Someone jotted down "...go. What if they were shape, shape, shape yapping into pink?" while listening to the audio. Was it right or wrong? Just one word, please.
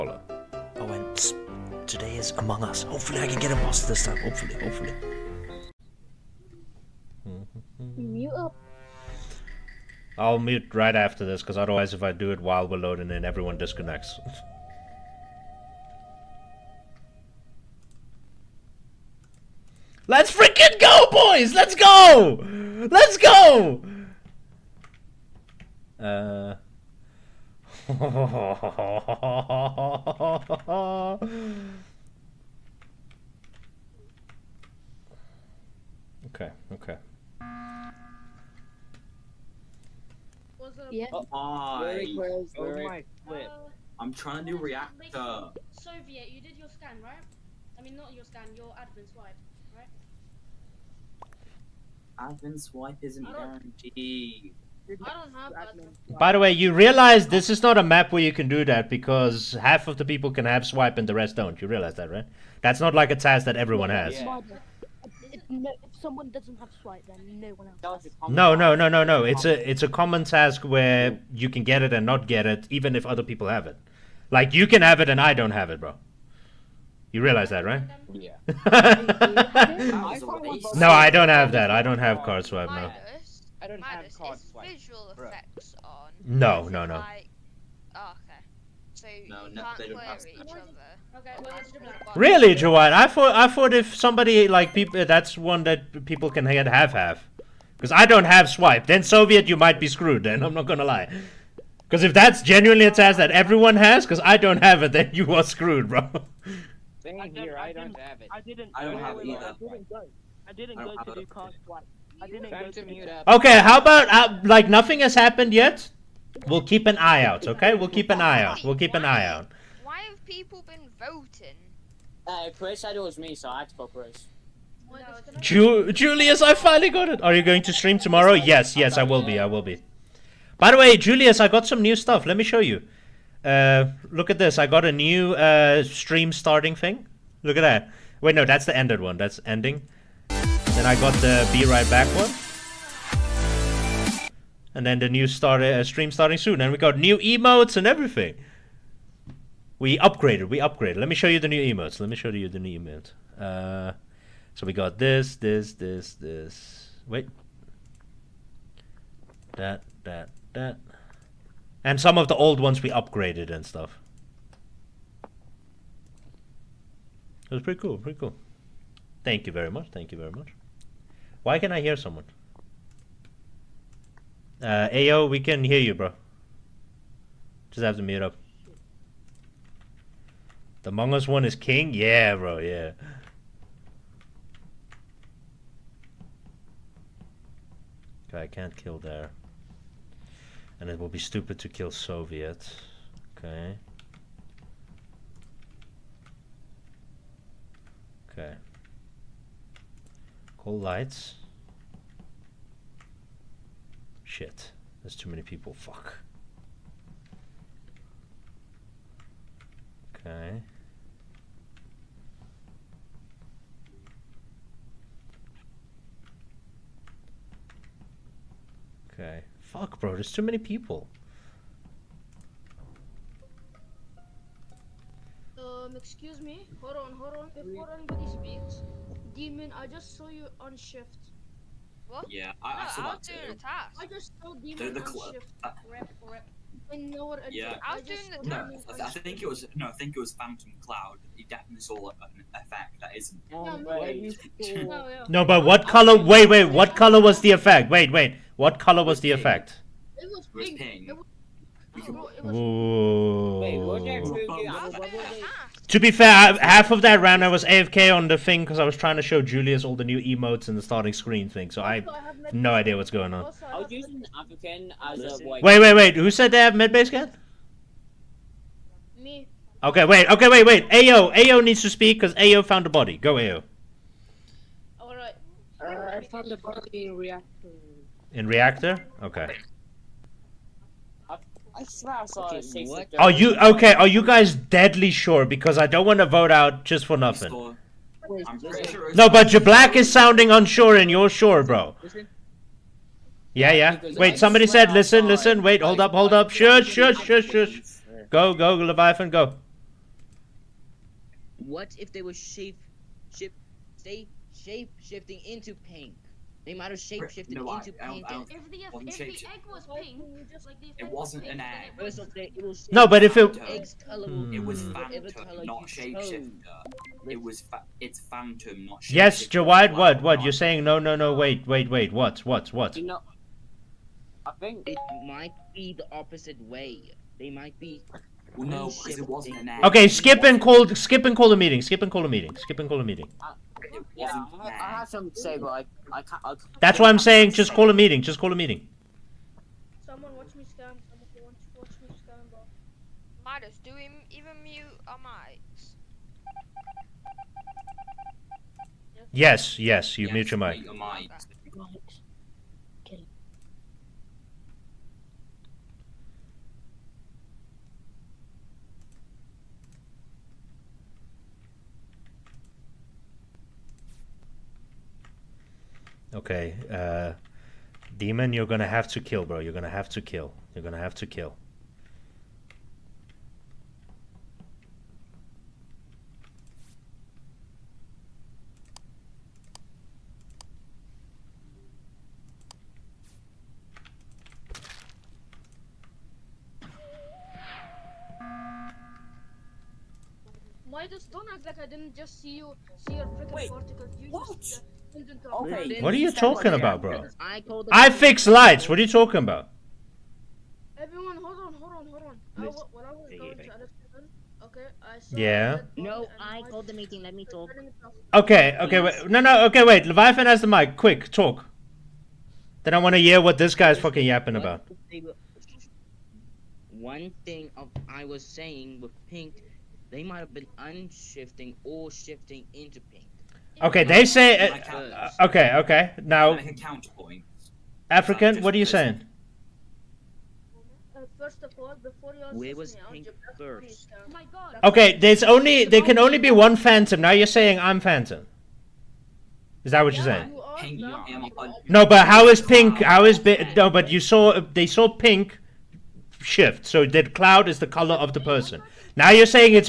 wrong.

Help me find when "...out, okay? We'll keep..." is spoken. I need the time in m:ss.
1:57.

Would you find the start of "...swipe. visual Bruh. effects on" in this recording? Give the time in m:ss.
1:24.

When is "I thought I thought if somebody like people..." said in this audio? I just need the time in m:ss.
1:32.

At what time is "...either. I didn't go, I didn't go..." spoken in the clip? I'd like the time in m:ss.
1:49.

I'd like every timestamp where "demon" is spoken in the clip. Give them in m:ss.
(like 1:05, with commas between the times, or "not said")
3:49, 3:54, 6:08.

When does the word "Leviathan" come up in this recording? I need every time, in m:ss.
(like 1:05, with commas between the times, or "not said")
4:58, 6:50.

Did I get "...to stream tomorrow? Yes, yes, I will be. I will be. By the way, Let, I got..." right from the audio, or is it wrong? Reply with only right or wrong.
wrong.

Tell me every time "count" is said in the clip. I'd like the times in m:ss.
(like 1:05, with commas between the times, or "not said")
7:06.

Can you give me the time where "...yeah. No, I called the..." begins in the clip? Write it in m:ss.
6:45.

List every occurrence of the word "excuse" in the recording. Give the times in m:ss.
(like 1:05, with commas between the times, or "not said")
3:45.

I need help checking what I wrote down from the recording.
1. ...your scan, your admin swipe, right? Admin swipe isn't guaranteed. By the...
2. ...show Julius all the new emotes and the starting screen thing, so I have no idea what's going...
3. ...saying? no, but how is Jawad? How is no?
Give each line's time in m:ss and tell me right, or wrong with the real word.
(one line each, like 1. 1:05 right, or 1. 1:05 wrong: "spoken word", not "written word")
1. 0:48 right
2. 4:19 right
3. 7:20 wrong: "Pink", not "Jawad".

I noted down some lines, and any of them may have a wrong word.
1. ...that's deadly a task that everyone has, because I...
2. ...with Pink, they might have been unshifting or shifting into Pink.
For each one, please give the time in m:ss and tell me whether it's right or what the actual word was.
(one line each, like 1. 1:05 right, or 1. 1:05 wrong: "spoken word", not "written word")
1. 1:42 wrong: "genuinely", not "deadly"
2. 6:59 right.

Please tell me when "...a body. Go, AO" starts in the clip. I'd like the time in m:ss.
4:32.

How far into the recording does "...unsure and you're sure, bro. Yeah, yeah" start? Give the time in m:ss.
4:50.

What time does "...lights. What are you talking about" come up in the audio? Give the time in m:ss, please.
6:38.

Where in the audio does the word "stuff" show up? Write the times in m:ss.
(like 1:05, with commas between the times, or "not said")
2:11, 2:43.